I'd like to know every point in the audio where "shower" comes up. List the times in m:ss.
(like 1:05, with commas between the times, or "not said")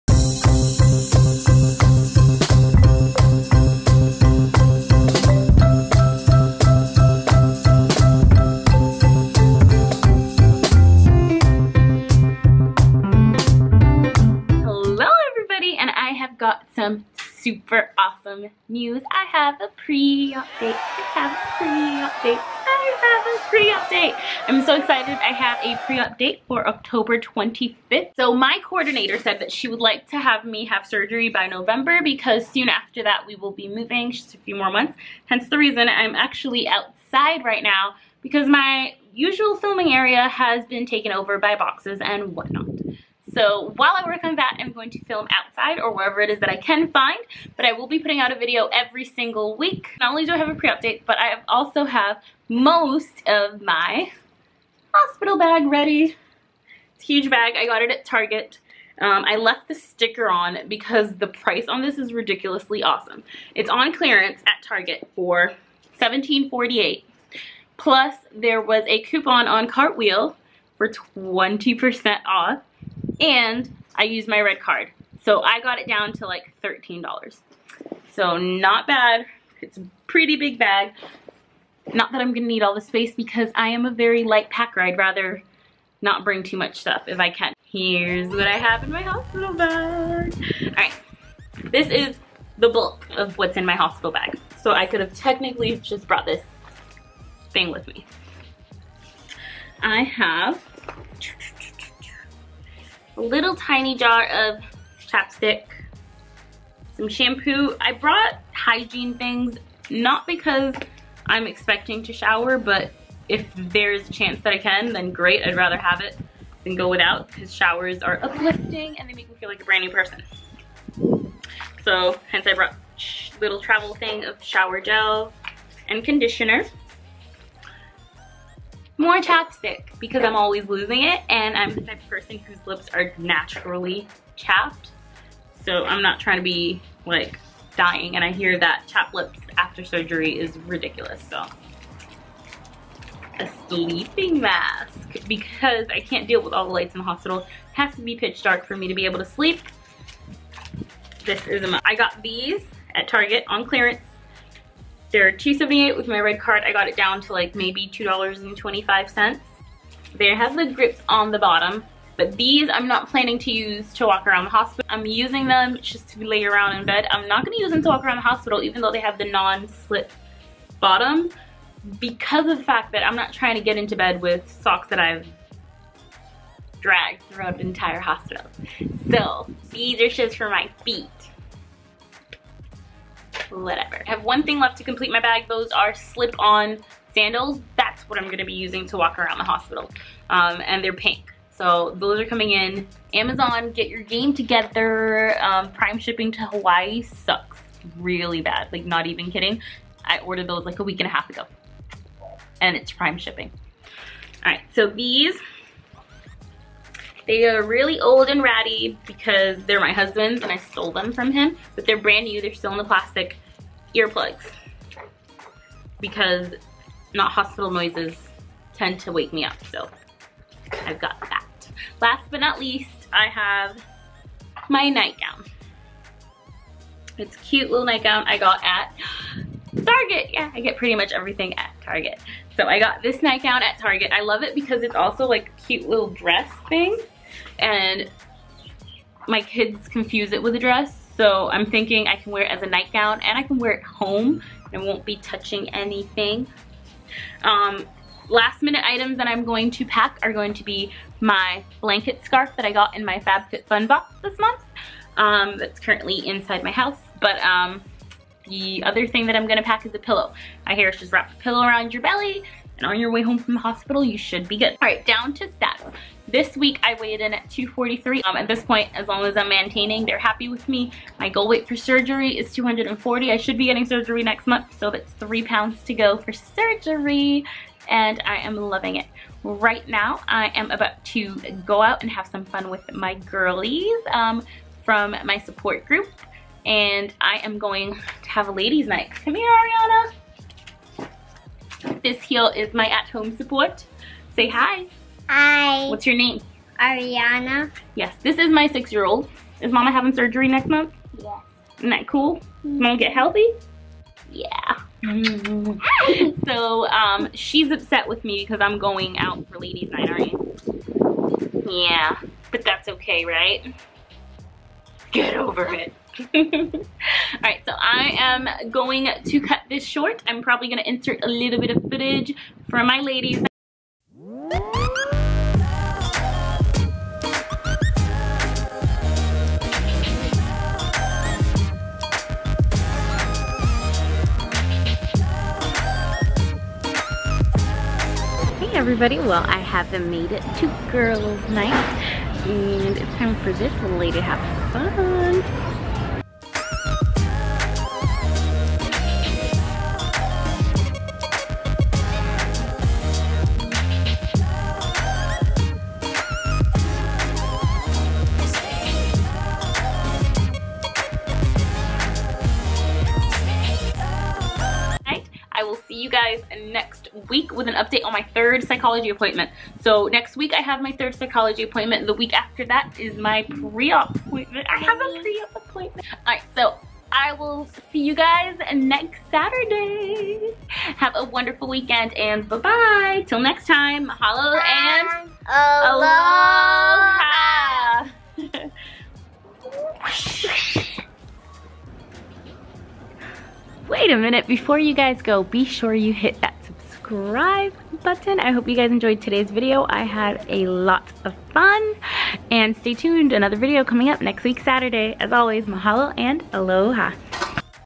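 1:52, 1:57, 2:04.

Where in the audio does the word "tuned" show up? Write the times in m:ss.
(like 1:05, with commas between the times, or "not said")
6:42.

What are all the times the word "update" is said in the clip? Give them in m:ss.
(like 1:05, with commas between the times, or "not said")
0:50, 6:07.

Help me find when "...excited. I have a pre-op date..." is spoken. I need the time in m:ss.
0:24.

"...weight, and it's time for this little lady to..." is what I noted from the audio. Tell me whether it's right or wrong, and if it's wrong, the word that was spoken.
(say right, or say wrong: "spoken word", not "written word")
wrong: "night", not "weight".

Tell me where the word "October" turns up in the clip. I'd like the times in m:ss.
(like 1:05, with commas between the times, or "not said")
0:26.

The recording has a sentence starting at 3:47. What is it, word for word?
It's cute little nightgown I got at Target.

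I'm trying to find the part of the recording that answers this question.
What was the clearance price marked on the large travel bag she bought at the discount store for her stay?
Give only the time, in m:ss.
1:06.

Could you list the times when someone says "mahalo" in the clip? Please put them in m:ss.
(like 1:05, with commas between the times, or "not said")
6:24, 6:45.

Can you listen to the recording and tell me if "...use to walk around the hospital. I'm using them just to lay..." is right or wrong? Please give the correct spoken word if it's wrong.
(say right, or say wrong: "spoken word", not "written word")
right.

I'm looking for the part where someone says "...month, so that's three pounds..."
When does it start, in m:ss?
4:34.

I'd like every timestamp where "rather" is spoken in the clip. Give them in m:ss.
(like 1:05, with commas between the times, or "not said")
1:24, 1:55.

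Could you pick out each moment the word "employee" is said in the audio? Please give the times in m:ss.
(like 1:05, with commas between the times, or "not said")
not said.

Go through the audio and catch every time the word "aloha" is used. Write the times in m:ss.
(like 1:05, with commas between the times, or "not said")
6:25, 6:46.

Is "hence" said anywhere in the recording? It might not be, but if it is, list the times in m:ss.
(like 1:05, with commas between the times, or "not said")
0:35, 2:02.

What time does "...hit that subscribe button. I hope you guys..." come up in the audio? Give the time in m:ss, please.
6:36.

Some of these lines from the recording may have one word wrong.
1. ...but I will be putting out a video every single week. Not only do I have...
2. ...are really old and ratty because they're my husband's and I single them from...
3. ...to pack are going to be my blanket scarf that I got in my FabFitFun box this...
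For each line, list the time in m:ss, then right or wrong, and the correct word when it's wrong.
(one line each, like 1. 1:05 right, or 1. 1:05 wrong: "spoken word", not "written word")
1. 0:47 right
2. 3:27 wrong: "stole", not "single"
3. 4:09 right.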